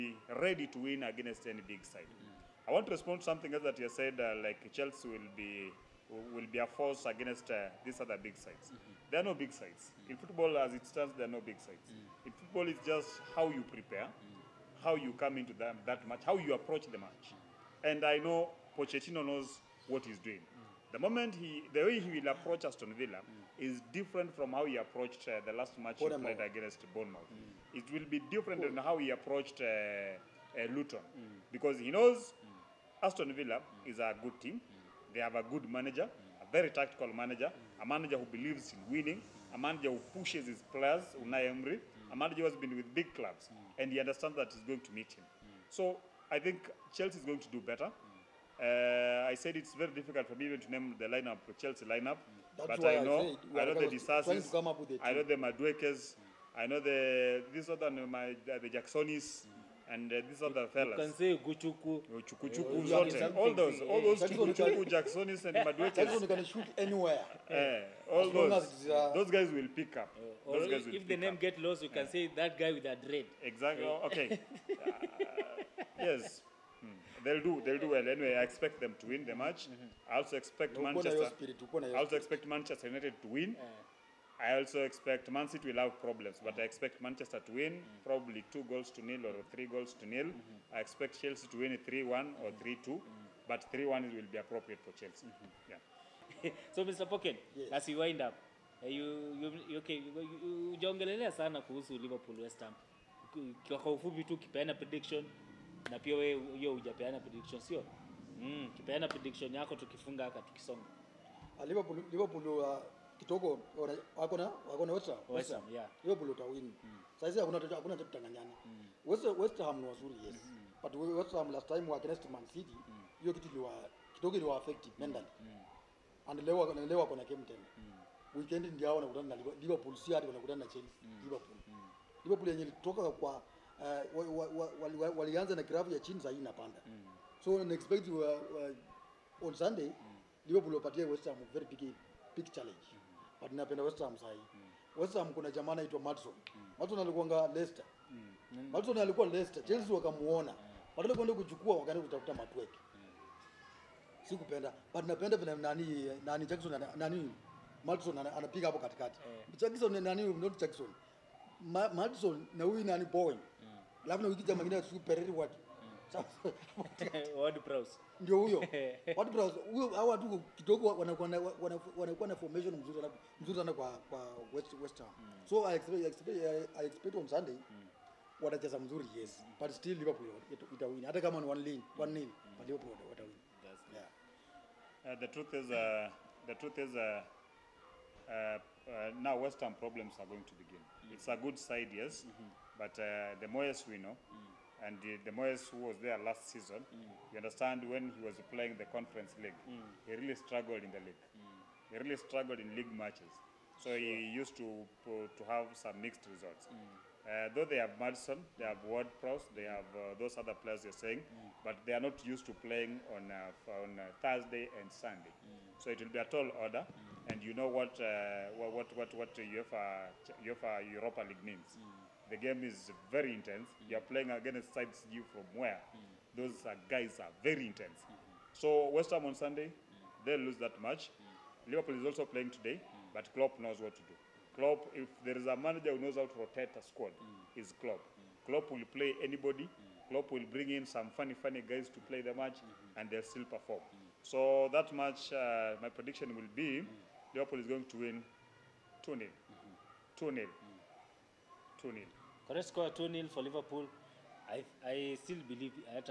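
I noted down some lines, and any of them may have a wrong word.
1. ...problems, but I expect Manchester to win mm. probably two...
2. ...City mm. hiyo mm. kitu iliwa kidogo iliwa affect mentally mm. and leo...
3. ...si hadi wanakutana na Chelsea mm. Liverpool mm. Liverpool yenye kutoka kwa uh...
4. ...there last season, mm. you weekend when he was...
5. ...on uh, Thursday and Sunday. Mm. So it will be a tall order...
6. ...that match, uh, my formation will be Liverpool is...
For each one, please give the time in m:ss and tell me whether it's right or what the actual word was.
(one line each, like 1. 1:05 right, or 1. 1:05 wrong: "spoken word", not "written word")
1. 1:26 right
2. 2:02 right
3. 2:09 right
4. 3:16 wrong: "understand", not "weekend"
5. 3:33 right
6. 4:04 wrong: "prediction", not "formation".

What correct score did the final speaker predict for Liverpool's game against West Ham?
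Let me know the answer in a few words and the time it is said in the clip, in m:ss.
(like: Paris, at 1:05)
2-0, at 4:12.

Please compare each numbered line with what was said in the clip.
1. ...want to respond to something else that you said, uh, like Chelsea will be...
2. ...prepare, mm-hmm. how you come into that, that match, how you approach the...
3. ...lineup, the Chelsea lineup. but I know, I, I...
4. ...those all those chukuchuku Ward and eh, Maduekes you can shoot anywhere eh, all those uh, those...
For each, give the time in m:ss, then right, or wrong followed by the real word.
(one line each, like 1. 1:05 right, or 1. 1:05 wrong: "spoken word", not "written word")
1. 0:02 right
2. 0:13 right
3. 0:51 right
4. 1:03 wrong: "Jacksonis", not "Ward".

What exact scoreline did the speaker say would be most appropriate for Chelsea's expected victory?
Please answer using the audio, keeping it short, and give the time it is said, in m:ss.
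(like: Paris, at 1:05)
3-1, at 1:33.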